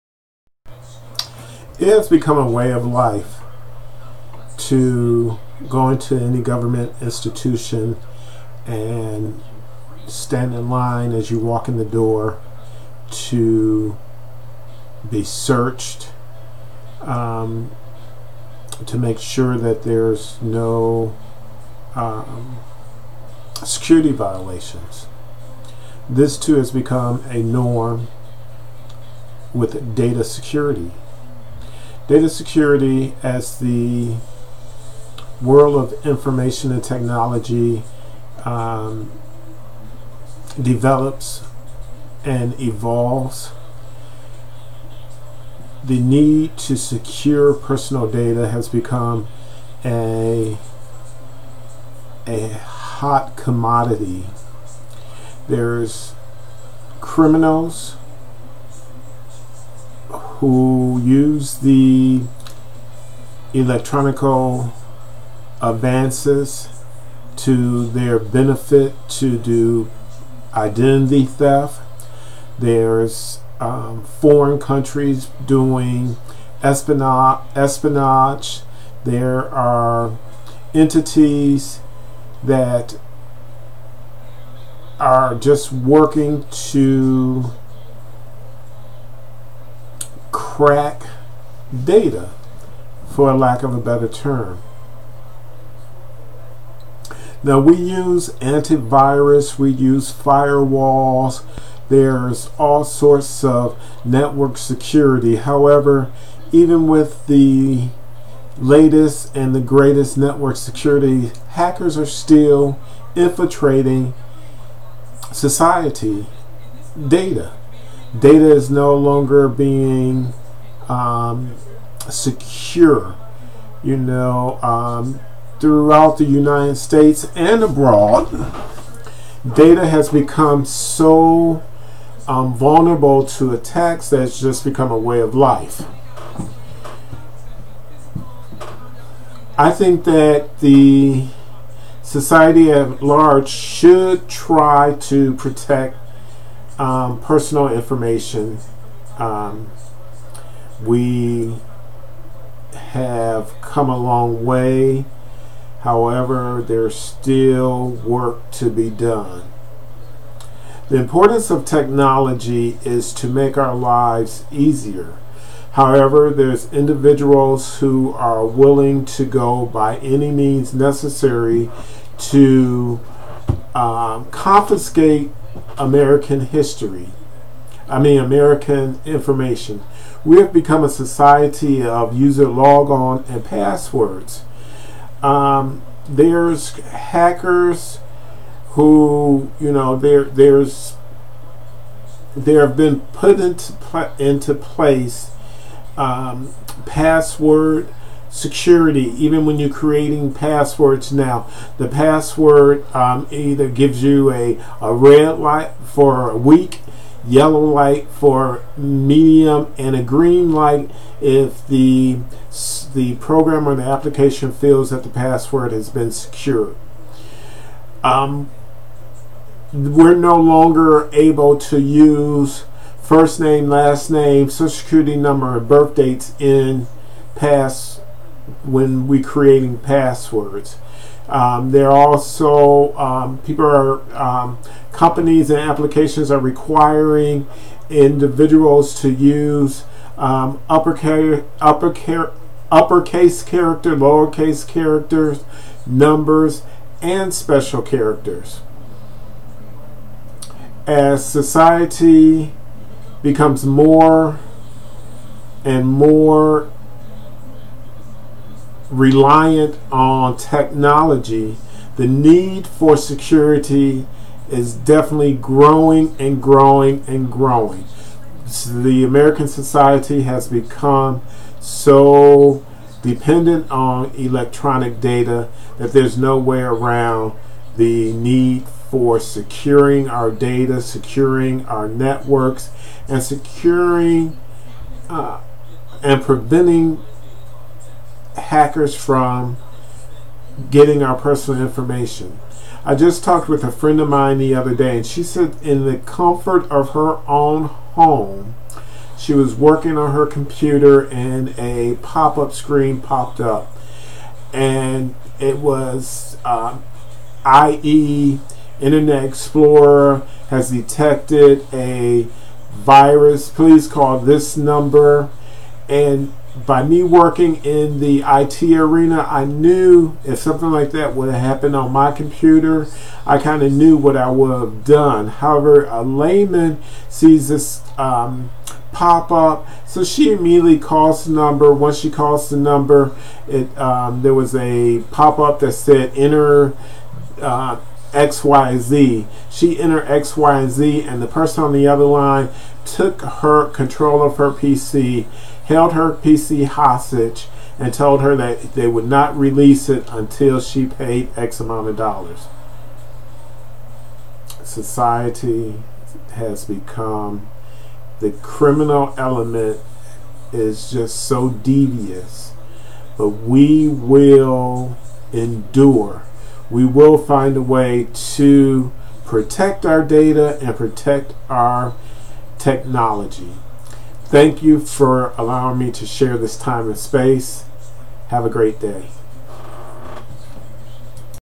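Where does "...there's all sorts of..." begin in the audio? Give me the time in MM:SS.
01:41.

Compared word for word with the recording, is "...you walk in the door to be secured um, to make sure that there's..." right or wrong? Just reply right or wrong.
wrong.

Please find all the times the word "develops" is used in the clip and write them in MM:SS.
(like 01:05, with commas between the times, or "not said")
00:40.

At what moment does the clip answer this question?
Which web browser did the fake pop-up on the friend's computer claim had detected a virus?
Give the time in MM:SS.
05:08.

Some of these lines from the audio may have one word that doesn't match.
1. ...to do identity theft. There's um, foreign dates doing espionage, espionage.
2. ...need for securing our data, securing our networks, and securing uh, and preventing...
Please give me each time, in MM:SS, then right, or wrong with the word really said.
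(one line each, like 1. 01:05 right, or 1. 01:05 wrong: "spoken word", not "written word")
1. 01:09 wrong: "countries", not "dates"
2. 04:38 right.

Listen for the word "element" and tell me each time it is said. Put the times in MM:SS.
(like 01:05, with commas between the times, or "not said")
05:59.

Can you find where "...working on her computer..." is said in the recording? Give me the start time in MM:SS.
04:59.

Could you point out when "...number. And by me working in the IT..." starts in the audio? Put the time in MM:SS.
05:14.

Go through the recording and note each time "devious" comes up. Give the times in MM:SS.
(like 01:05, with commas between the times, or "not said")
06:01.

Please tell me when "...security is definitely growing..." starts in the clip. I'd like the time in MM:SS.
04:22.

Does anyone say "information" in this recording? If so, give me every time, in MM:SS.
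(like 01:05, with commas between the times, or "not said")
00:36, 02:27, 02:59, 04:51.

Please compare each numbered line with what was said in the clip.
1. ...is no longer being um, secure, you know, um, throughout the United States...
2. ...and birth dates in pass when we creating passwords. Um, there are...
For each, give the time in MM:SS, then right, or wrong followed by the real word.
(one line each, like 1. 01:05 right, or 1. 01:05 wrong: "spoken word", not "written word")
1. 01:58 right
2. 03:45 right.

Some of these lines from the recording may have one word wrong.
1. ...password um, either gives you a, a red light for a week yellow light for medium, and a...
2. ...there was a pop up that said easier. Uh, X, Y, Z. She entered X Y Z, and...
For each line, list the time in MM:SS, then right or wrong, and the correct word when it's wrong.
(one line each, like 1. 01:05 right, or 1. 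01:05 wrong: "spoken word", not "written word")
1. 03:21 right
2. 05:34 wrong: "enter", not "easier".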